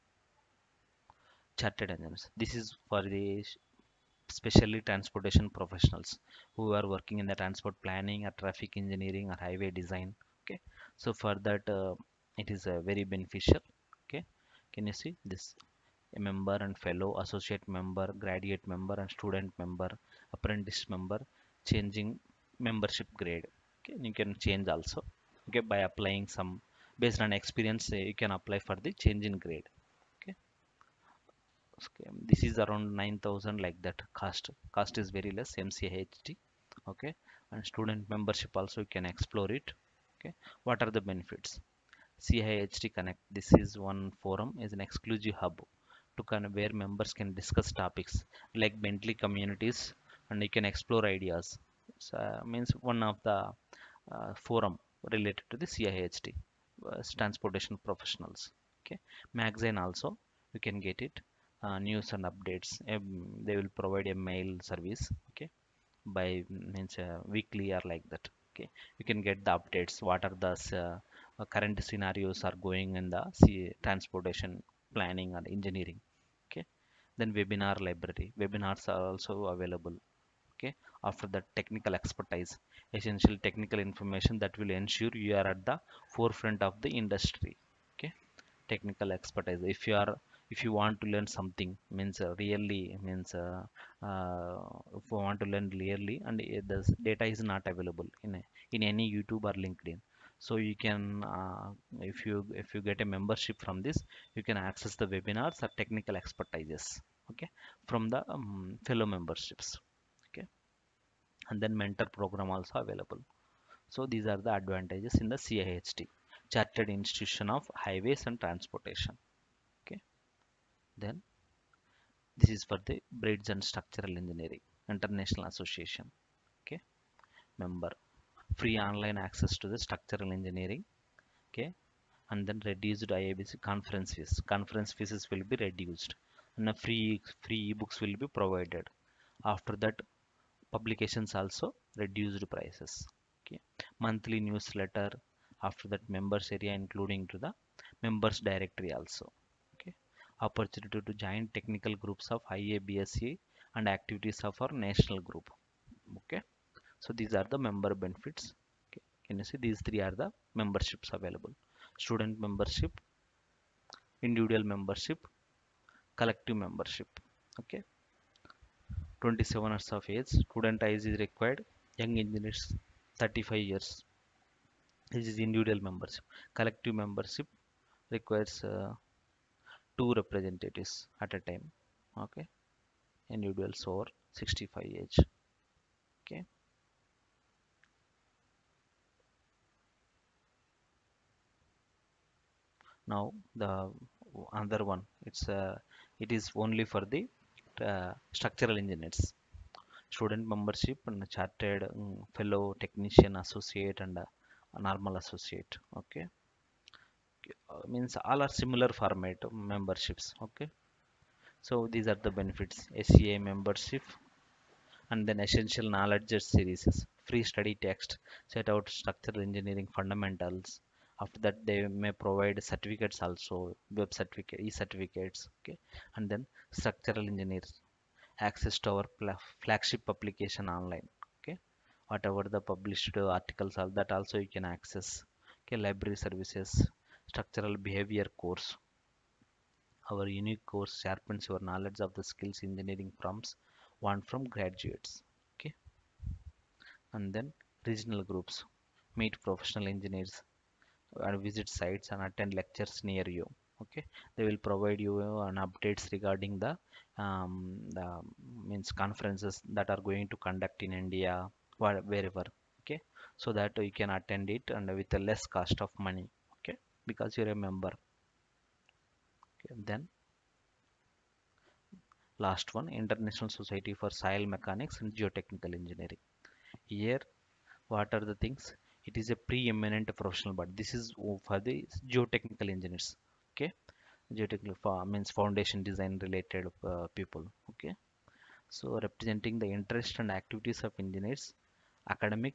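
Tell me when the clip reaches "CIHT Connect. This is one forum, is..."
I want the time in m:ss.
0:42.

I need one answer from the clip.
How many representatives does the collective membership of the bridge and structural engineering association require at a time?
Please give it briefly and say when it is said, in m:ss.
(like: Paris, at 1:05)
2, at 2:59.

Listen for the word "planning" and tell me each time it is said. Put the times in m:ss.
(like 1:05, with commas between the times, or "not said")
0:07, 1:14.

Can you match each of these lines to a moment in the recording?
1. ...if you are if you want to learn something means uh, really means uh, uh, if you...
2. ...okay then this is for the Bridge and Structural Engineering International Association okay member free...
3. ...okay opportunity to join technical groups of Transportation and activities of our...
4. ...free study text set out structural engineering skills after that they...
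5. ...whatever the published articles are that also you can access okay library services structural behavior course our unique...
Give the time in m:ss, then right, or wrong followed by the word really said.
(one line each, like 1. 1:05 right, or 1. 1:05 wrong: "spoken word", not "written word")
1. 1:29 right
2. 1:59 right
3. 2:29 wrong: "IABSE", not "Transportation"
4. 3:37 wrong: "fundamentals", not "skills"
5. 3:52 right.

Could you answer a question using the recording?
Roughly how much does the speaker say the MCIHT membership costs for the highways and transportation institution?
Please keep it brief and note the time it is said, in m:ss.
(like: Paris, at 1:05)
9000, at 0:32.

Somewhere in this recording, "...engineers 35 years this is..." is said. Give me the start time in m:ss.
2:52.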